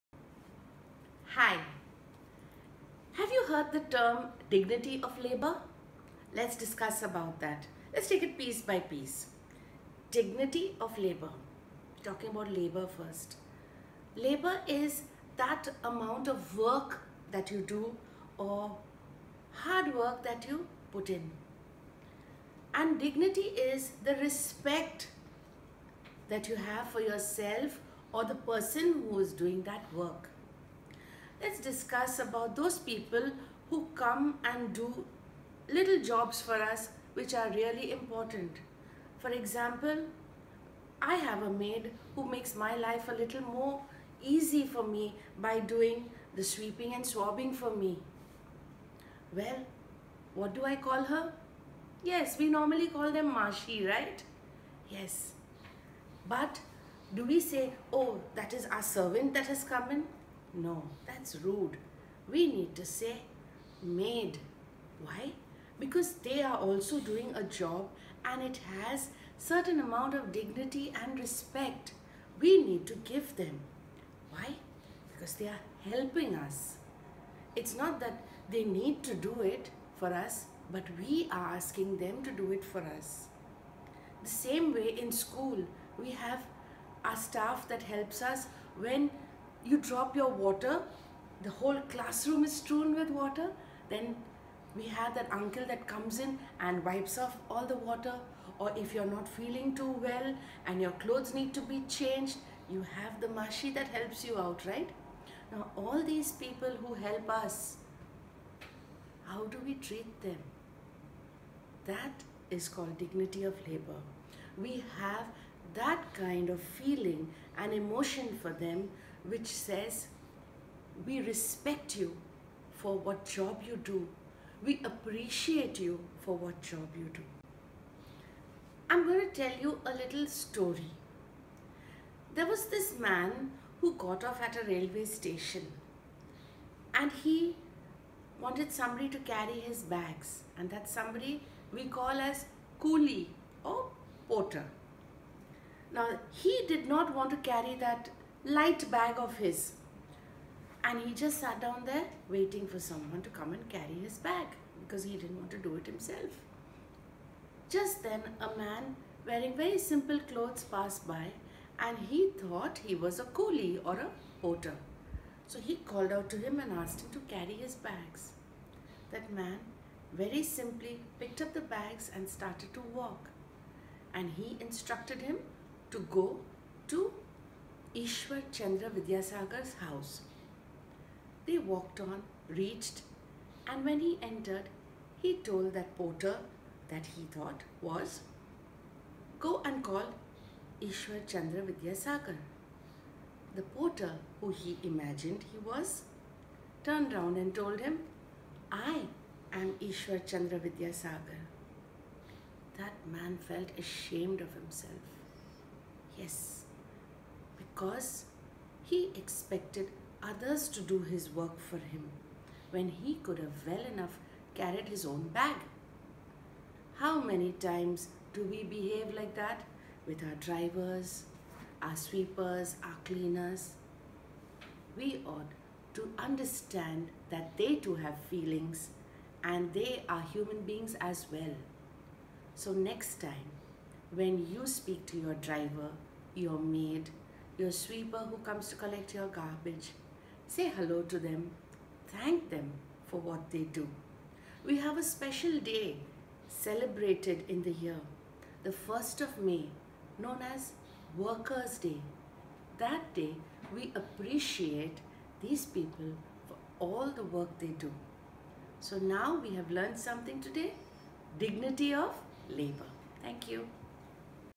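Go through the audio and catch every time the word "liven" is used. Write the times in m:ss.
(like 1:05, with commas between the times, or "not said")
not said.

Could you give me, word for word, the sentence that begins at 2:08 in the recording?
I'm going to tell you a little story.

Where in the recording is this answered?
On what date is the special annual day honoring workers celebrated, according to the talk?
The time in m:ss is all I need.
4:08.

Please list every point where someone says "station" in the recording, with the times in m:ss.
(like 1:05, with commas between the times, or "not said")
2:15.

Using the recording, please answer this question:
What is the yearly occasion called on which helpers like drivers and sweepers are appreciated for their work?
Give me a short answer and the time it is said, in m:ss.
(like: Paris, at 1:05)
Workers' Day, at 4:11.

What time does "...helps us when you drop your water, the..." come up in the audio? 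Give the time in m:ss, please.
1:27.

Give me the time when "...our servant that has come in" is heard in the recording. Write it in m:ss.
0:58.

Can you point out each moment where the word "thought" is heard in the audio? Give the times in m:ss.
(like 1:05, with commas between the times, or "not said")
2:42, 3:07.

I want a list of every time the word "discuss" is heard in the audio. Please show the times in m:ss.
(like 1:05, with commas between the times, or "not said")
0:06, 0:31.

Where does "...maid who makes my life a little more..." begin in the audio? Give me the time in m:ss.
0:41.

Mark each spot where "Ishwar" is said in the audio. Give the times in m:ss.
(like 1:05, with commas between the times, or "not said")
2:57, 3:10, 3:19.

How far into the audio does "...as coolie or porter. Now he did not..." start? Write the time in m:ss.
2:22.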